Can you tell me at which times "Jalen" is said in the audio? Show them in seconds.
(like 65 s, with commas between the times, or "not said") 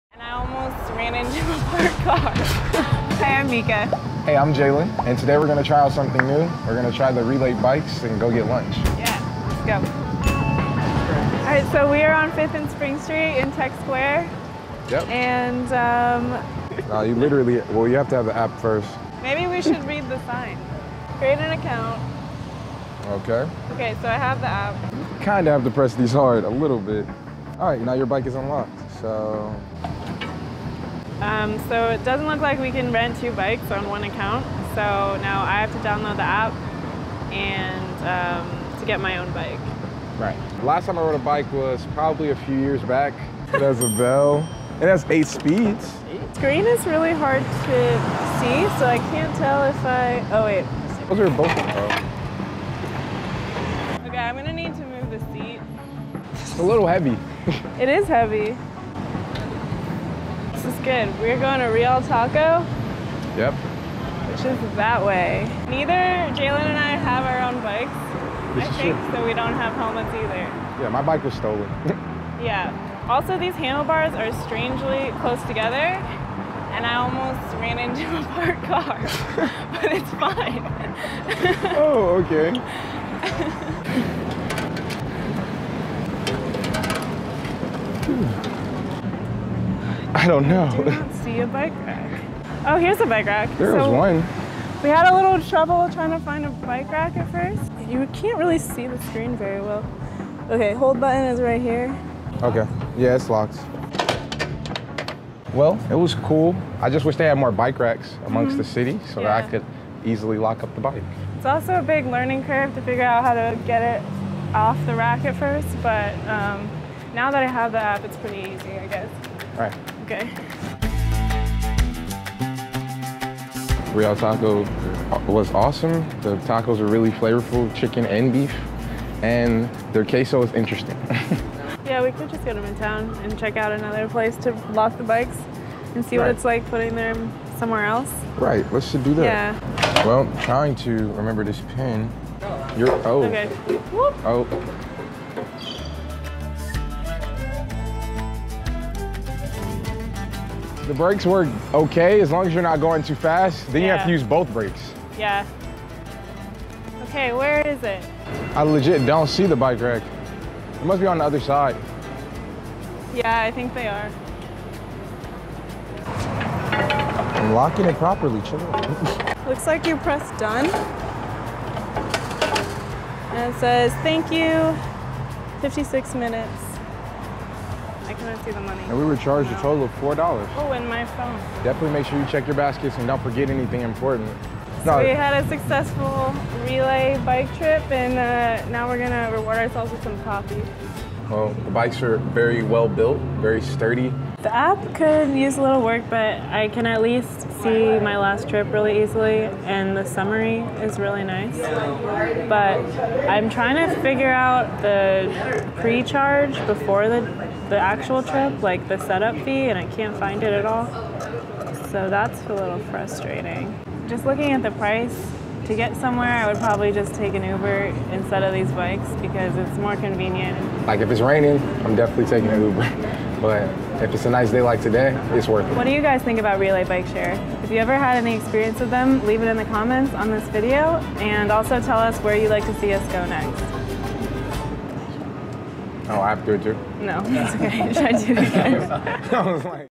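4 s, 66 s.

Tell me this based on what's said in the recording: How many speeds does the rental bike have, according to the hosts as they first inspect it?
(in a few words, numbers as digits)
8.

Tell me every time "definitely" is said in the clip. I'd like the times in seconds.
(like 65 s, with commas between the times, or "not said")
181 s, 221 s.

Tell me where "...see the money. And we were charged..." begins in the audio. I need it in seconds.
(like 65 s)
178 s.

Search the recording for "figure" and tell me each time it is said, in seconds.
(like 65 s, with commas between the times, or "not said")
112 s, 204 s.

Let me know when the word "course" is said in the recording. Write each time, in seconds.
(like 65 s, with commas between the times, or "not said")
not said.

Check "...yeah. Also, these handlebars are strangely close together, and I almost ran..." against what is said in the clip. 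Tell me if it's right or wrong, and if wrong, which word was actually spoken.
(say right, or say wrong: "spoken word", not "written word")
right.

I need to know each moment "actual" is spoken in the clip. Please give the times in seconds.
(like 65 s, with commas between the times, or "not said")
207 s.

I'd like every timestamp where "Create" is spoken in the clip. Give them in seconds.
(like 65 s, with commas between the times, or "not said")
21 s.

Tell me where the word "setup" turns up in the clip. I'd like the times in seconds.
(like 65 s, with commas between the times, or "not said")
208 s.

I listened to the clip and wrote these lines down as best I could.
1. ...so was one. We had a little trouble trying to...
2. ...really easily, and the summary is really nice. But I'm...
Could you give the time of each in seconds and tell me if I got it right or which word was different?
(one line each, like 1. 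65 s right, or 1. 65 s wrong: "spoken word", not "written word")
1. 93 s right
2. 198 s right.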